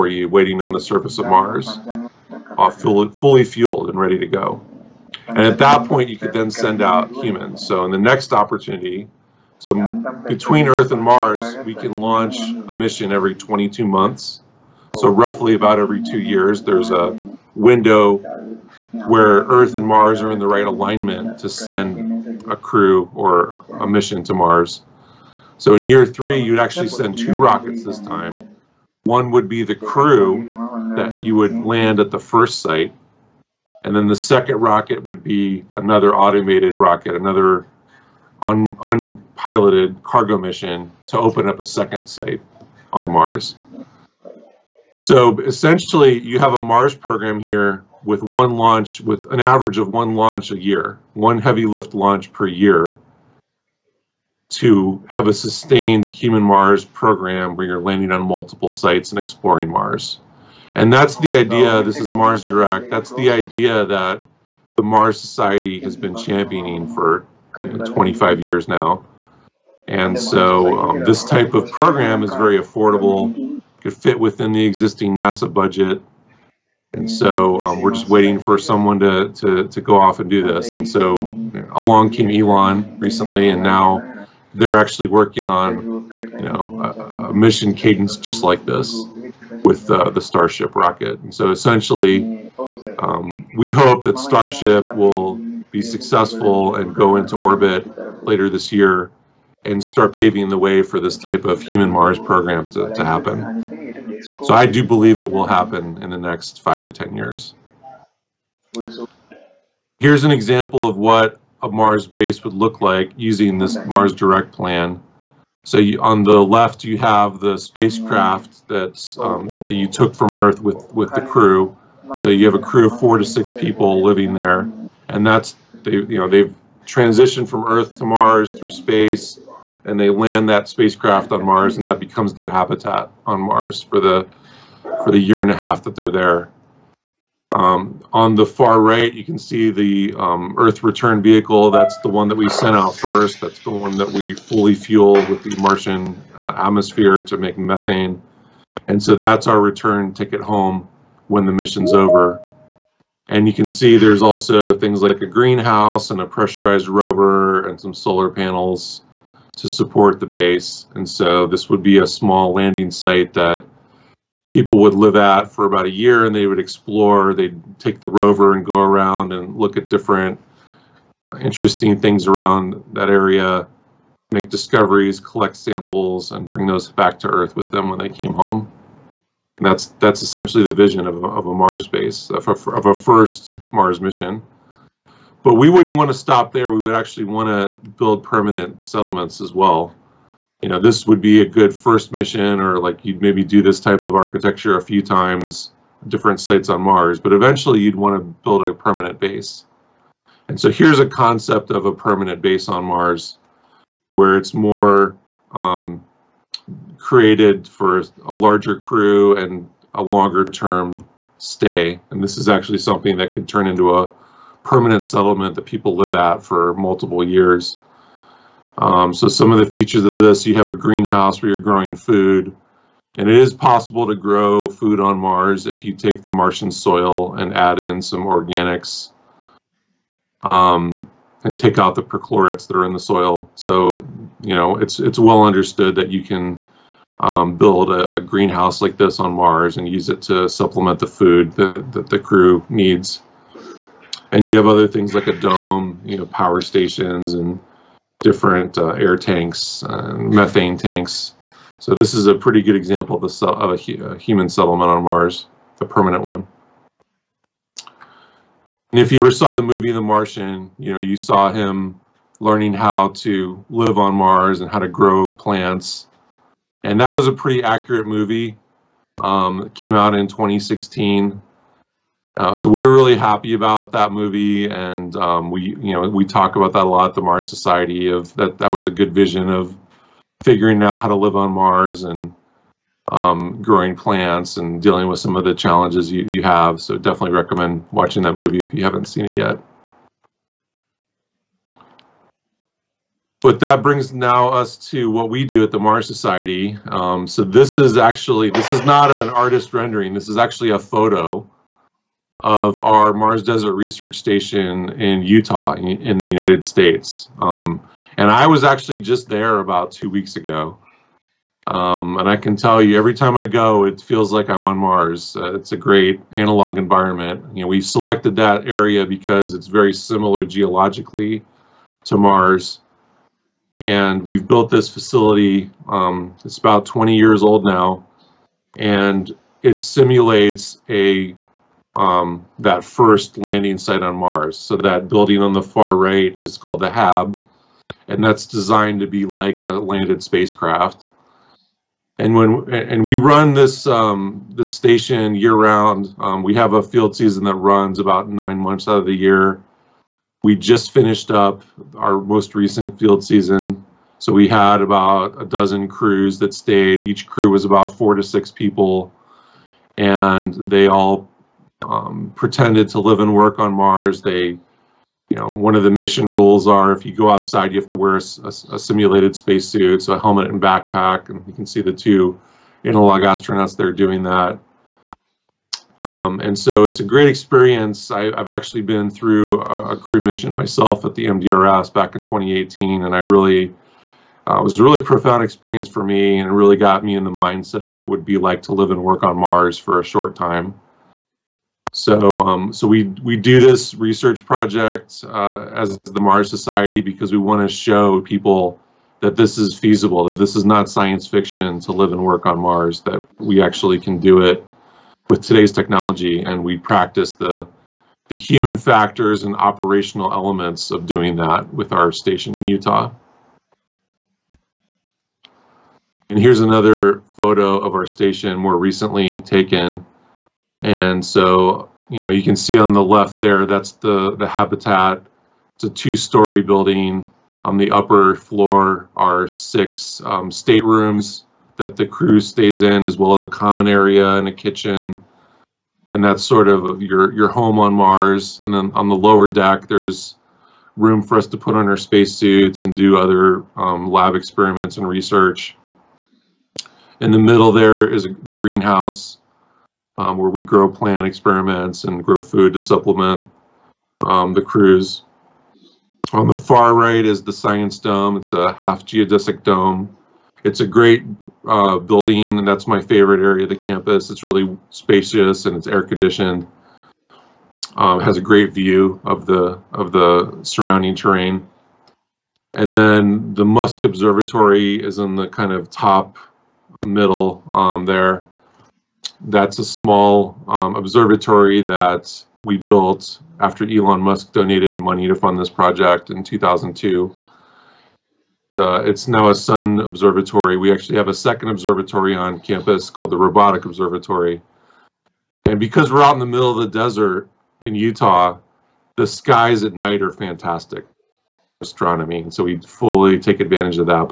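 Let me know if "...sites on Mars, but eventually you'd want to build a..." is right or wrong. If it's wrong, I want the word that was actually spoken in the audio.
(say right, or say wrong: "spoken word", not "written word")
right.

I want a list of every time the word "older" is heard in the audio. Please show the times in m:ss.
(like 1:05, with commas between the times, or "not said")
not said.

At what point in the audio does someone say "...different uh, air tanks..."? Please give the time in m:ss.
4:08.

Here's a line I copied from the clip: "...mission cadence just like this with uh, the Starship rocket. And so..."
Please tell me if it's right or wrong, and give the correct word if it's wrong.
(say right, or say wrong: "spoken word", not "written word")
right.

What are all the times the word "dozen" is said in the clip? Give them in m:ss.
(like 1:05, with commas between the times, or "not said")
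5:55.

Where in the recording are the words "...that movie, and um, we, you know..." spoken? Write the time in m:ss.
4:33.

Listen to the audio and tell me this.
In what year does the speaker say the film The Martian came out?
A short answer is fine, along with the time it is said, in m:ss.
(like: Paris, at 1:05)
2016, at 4:30.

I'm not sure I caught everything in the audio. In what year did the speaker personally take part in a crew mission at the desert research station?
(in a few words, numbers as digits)
2018.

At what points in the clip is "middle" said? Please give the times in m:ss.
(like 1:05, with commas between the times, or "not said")
7:27, 7:57, 8:16.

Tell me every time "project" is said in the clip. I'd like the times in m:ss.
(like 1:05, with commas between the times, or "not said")
6:34, 8:05.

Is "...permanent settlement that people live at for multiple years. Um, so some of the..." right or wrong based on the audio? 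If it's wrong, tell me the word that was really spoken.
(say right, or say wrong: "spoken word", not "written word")
right.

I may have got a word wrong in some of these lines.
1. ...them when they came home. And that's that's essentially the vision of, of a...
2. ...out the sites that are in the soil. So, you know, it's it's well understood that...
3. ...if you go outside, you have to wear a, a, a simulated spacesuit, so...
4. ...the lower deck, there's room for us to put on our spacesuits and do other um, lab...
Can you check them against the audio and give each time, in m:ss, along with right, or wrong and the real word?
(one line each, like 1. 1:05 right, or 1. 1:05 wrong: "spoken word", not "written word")
1. 2:57 right
2. 3:51 wrong: "perchlorates", not "sites"
3. 6:06 right
4. 7:19 right.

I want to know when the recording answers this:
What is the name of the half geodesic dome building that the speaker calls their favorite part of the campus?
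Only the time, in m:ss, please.
7:37.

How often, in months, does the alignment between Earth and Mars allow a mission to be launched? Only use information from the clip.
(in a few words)
22.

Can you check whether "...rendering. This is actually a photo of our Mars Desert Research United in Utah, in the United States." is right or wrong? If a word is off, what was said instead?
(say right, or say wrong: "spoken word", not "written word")
wrong: "Station", not "United".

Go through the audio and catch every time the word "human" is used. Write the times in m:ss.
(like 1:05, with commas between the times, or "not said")
0:07, 0:56, 1:41, 4:14, 6:48.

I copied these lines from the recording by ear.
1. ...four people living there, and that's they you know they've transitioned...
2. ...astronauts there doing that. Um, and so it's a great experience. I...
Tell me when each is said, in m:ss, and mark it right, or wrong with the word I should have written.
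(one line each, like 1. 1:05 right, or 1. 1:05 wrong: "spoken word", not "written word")
1. 2:03 wrong: "six", not "four"
2. 6:13 right.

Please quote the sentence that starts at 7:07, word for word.
On the upper floor are six um, staterooms that the crew stays in, as well as a common area and a kitchen.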